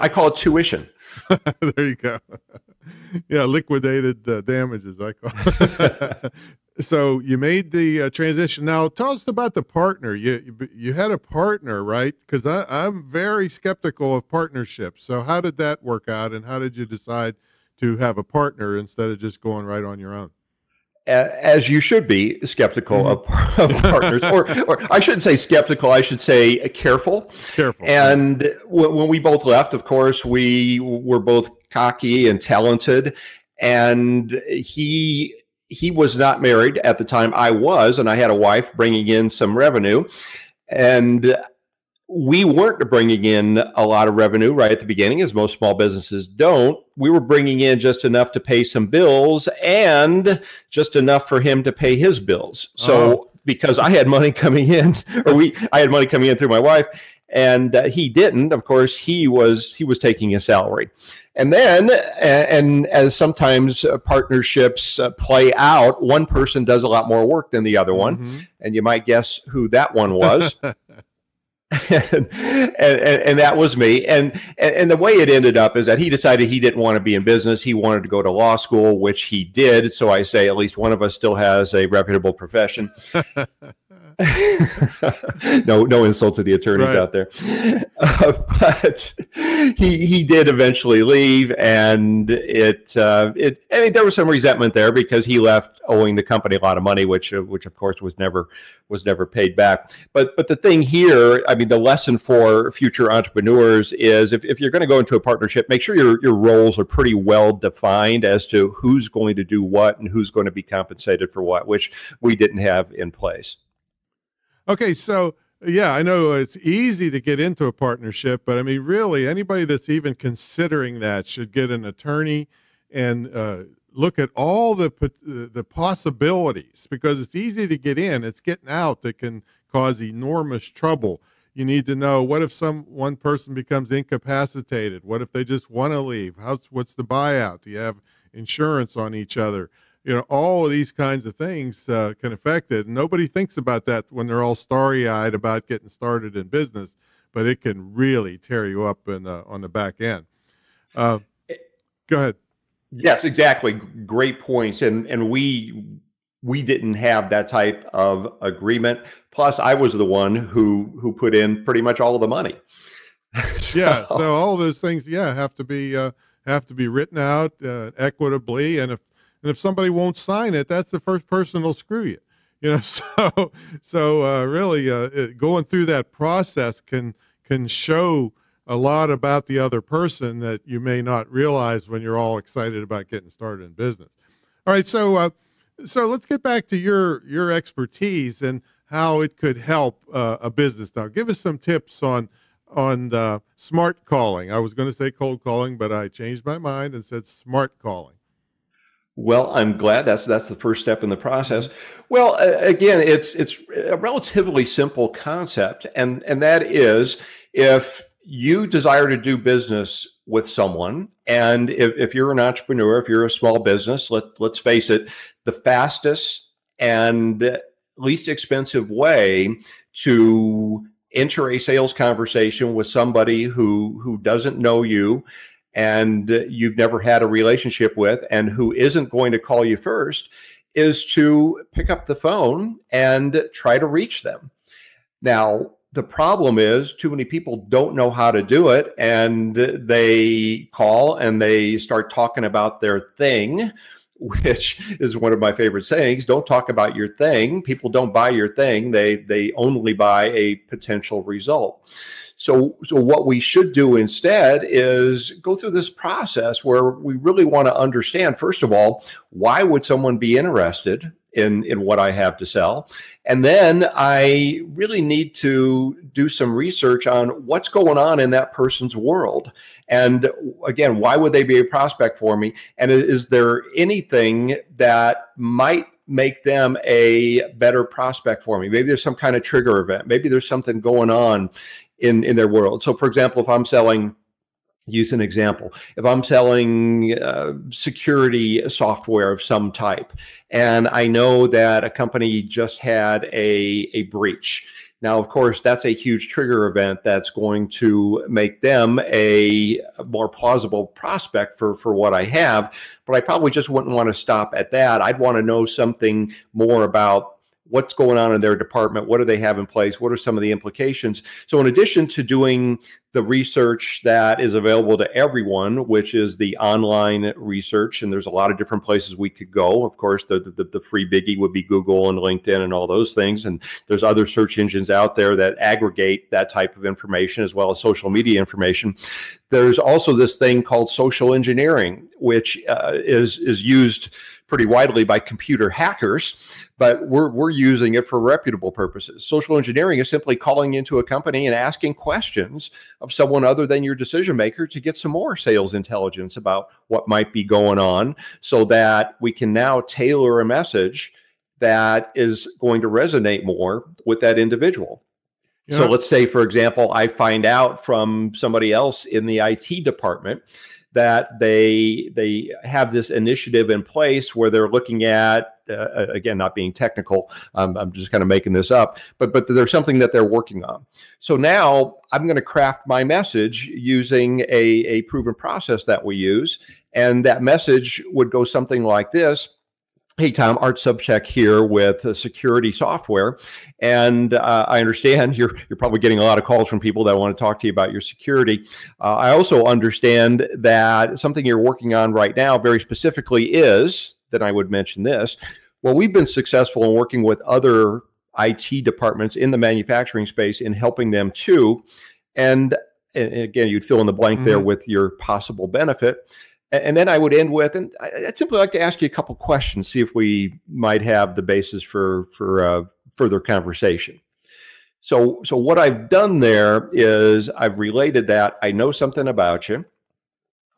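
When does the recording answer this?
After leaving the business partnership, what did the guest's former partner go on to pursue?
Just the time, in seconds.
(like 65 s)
78 s.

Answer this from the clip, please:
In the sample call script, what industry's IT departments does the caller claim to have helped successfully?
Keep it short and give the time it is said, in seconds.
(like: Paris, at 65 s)
Manufacturing, at 399 s.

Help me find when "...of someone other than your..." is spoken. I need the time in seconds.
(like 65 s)
343 s.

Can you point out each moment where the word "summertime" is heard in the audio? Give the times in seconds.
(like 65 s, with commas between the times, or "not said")
not said.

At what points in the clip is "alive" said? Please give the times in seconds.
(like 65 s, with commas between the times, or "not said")
not said.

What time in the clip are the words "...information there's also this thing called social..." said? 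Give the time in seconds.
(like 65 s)
328 s.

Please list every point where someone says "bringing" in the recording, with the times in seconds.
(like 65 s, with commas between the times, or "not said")
38 s, 42 s, 47 s.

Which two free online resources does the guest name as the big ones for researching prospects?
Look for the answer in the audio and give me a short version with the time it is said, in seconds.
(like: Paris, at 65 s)
Google and LinkedIn, at 321 s.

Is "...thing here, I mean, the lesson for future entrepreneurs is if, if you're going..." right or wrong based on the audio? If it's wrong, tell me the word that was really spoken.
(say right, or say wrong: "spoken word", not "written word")
right.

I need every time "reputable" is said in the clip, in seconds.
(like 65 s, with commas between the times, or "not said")
81 s, 338 s.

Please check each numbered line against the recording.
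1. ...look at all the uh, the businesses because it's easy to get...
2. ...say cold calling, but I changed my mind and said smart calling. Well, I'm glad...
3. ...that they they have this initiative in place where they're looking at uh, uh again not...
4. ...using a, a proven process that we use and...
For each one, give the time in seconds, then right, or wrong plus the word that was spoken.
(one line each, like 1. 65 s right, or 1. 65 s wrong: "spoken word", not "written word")
1. 123 s wrong: "possibilities", not "businesses"
2. 194 s right
3. 360 s right
4. 373 s right.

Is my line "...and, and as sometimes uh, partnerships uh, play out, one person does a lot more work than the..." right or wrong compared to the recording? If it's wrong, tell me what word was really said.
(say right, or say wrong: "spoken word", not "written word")
right.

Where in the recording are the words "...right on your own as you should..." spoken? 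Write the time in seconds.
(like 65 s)
19 s.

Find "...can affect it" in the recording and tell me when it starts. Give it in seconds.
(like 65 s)
142 s.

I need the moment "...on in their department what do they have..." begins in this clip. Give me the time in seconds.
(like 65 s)
308 s.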